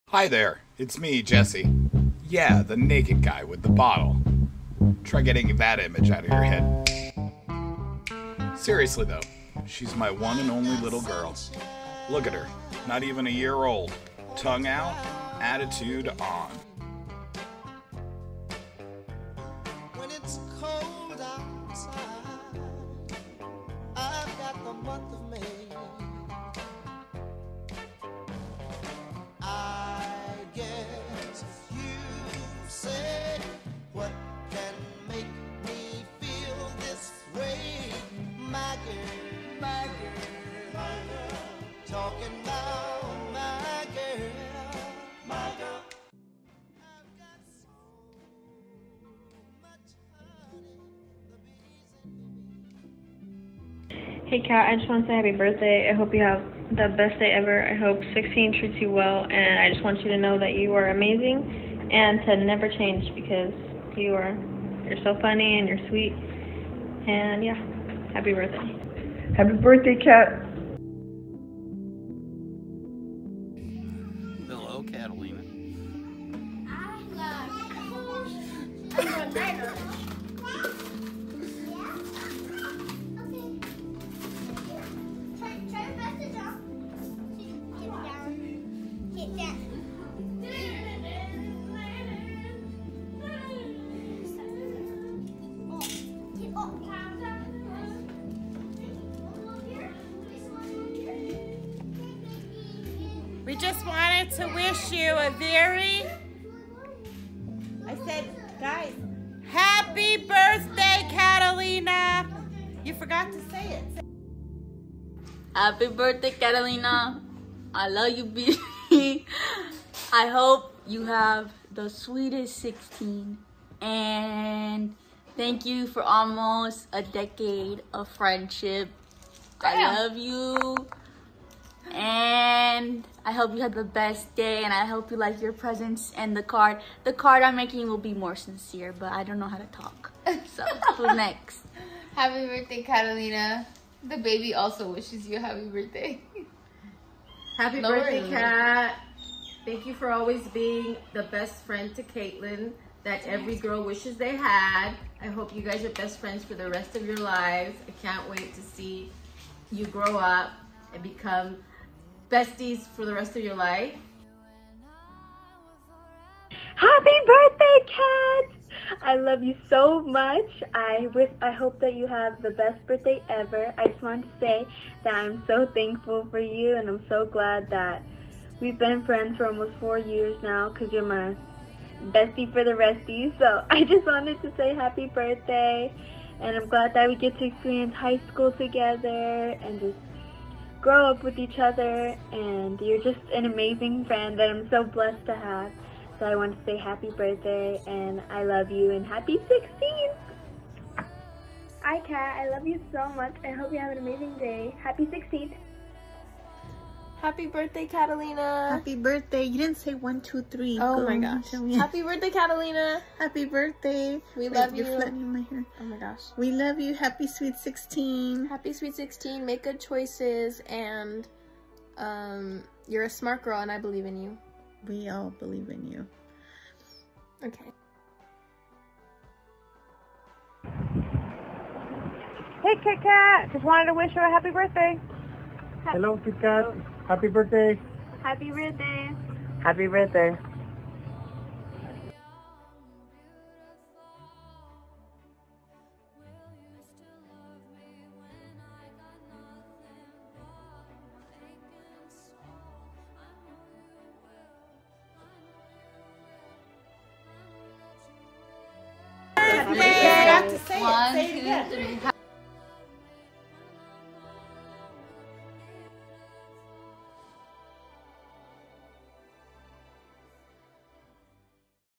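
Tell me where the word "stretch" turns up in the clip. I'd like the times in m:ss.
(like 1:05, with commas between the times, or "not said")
not said.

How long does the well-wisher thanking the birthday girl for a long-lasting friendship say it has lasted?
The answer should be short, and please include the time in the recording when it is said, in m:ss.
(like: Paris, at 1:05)
almost a decade, at 2:06.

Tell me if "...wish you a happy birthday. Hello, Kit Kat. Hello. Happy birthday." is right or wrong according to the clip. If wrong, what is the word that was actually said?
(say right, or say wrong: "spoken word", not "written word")
right.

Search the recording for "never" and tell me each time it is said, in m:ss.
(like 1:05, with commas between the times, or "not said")
1:02.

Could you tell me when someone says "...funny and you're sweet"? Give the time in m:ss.
1:05.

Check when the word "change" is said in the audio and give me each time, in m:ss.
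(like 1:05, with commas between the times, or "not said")
1:02.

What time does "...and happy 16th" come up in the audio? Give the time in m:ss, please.
3:18.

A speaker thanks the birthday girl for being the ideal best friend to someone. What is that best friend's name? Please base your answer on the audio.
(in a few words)
Caitlin.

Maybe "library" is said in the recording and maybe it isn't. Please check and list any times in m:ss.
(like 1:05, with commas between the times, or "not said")
not said.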